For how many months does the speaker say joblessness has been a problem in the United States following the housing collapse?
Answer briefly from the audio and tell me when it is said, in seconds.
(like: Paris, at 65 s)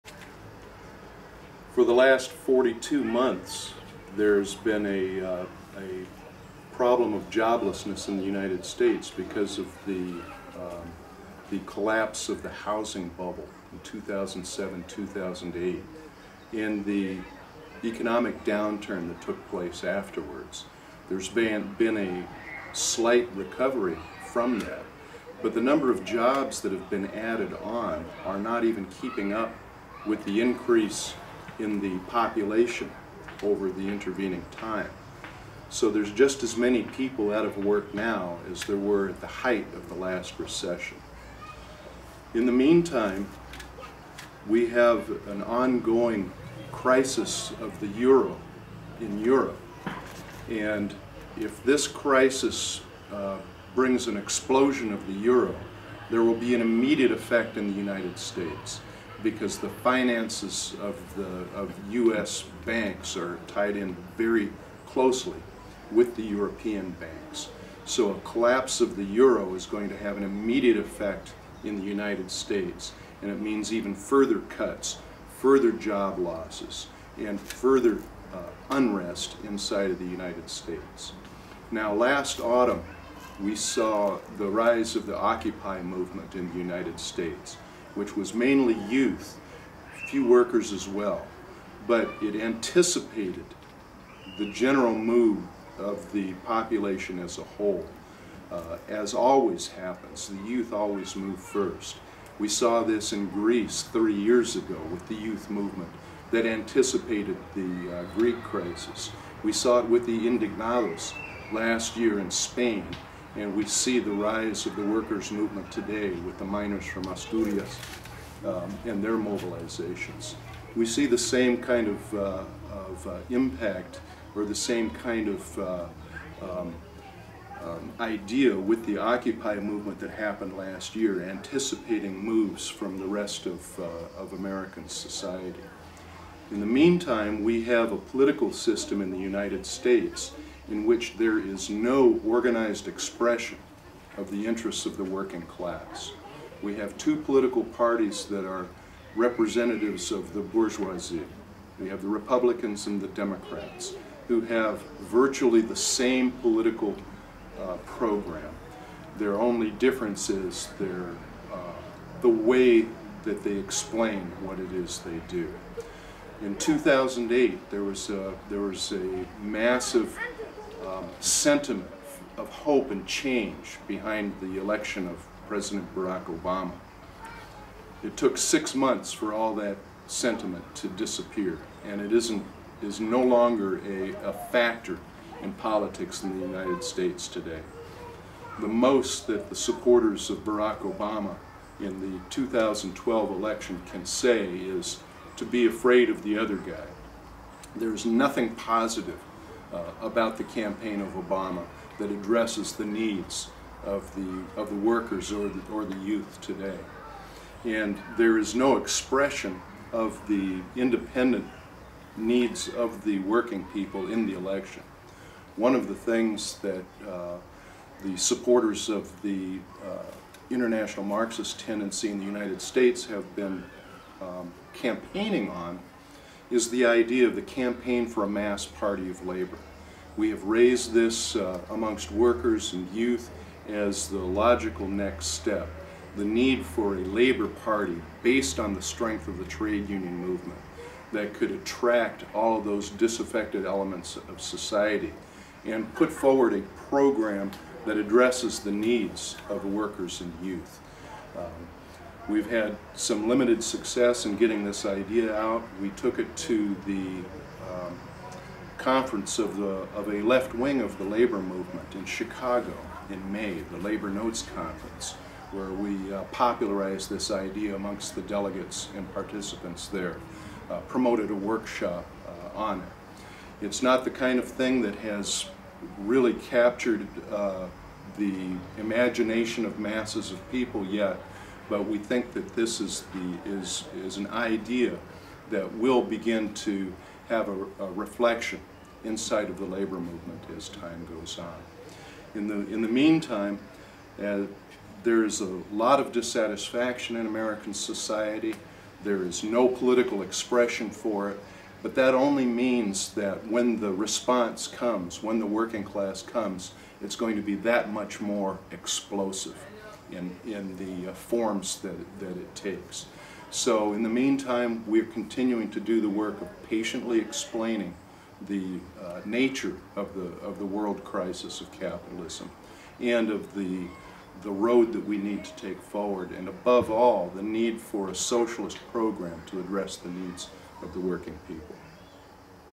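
42, at 2 s.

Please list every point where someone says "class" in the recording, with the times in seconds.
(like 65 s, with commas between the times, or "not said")
145 s, 305 s.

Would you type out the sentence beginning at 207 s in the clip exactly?
And there is no expression of the independent needs of the working people in the election.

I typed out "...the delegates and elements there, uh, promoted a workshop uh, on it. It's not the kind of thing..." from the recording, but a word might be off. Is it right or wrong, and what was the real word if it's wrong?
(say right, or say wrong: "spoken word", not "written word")
wrong: "participants", not "elements".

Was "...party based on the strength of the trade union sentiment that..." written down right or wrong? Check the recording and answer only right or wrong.
wrong.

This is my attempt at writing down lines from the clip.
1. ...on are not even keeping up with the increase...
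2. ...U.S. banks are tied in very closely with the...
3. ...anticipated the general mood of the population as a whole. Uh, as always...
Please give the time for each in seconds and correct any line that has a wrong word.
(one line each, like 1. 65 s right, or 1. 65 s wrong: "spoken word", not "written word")
1. 27 s right
2. 61 s right
3. 92 s right.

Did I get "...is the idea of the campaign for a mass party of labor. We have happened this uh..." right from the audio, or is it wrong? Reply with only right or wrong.
wrong.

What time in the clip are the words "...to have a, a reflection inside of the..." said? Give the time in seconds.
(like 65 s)
286 s.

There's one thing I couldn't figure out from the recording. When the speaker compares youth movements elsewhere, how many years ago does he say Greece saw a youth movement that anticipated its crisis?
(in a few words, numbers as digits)
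30 years.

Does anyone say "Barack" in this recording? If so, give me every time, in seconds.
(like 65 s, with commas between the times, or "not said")
175 s, 190 s.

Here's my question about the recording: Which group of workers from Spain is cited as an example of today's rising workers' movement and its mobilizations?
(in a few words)
miners from Asturias.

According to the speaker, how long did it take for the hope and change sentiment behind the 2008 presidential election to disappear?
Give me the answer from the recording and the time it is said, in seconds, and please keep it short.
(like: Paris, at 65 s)
six months, at 178 s.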